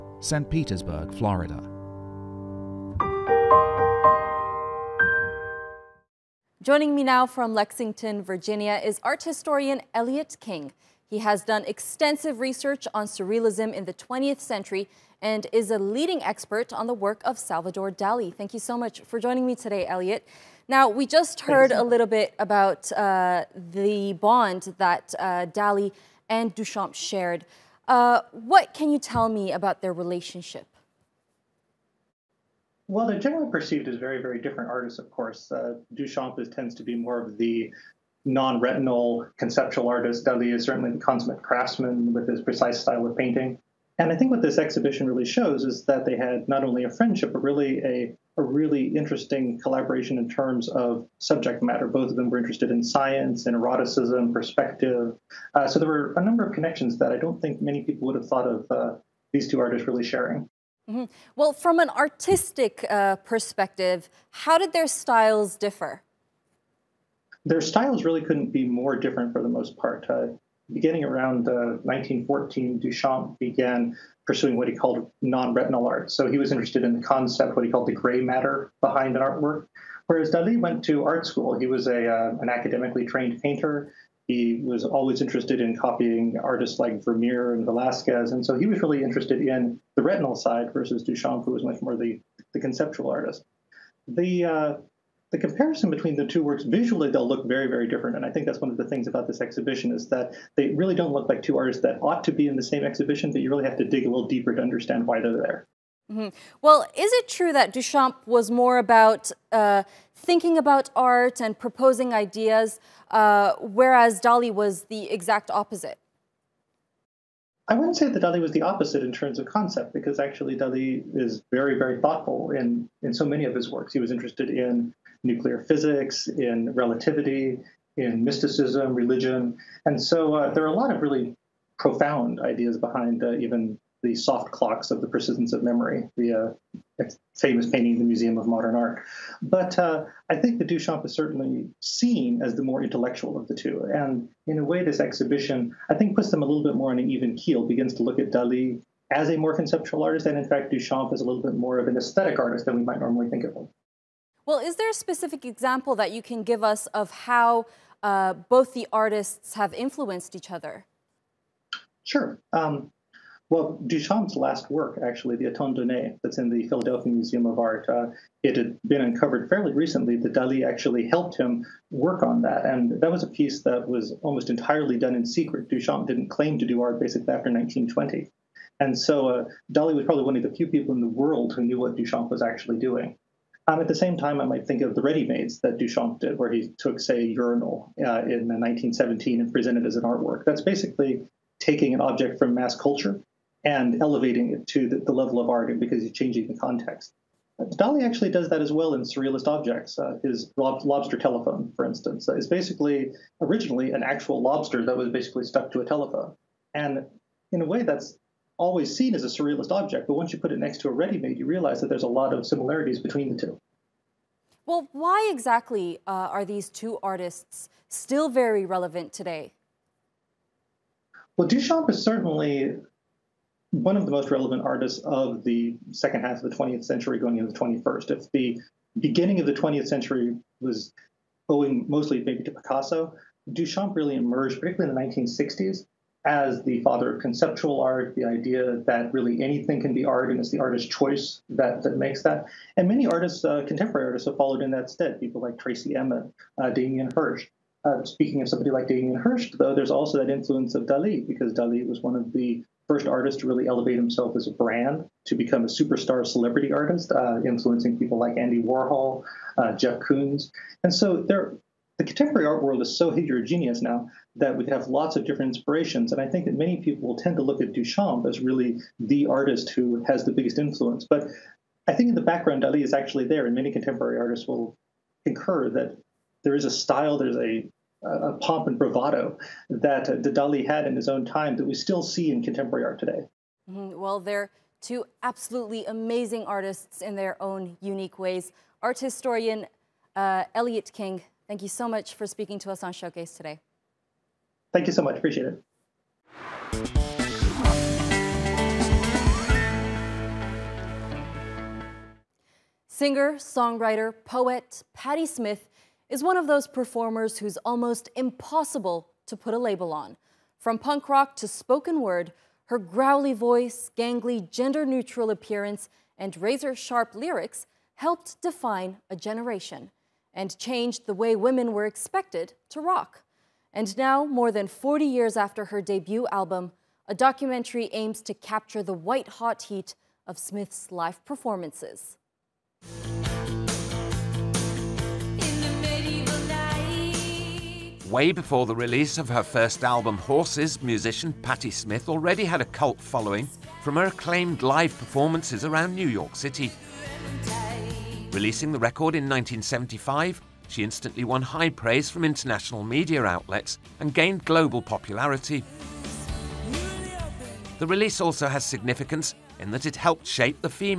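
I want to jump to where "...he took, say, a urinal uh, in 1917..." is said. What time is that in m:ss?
3:06.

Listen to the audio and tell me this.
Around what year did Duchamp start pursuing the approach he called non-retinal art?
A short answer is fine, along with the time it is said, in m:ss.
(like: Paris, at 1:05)
1914, at 1:11.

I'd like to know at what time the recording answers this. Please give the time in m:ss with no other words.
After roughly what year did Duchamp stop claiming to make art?
2:57.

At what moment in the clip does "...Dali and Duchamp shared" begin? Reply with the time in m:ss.
0:25.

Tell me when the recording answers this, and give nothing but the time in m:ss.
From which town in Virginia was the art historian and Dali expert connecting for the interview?
0:07.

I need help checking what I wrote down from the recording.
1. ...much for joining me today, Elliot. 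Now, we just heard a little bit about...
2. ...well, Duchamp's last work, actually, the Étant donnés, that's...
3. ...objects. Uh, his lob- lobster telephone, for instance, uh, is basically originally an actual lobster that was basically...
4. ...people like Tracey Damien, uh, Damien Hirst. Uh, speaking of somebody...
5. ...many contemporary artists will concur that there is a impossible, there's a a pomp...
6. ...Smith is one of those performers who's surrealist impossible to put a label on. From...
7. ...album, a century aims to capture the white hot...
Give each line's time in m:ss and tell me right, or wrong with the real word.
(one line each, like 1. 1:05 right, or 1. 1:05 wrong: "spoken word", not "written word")
1. 0:18 right
2. 2:43 right
3. 3:19 right
4. 4:05 wrong: "Emin", not "Damien"
5. 4:33 wrong: "style", not "impossible"
6. 5:05 wrong: "almost", not "surrealist"
7. 5:26 wrong: "documentary", not "century".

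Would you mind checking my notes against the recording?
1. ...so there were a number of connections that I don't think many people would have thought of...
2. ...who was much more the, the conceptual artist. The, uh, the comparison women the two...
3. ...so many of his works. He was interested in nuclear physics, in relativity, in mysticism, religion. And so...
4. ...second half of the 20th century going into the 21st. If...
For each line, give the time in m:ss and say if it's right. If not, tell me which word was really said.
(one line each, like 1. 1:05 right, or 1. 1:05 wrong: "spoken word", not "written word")
1. 0:55 right
2. 1:31 wrong: "between", not "women"
3. 2:03 right
4. 3:45 right.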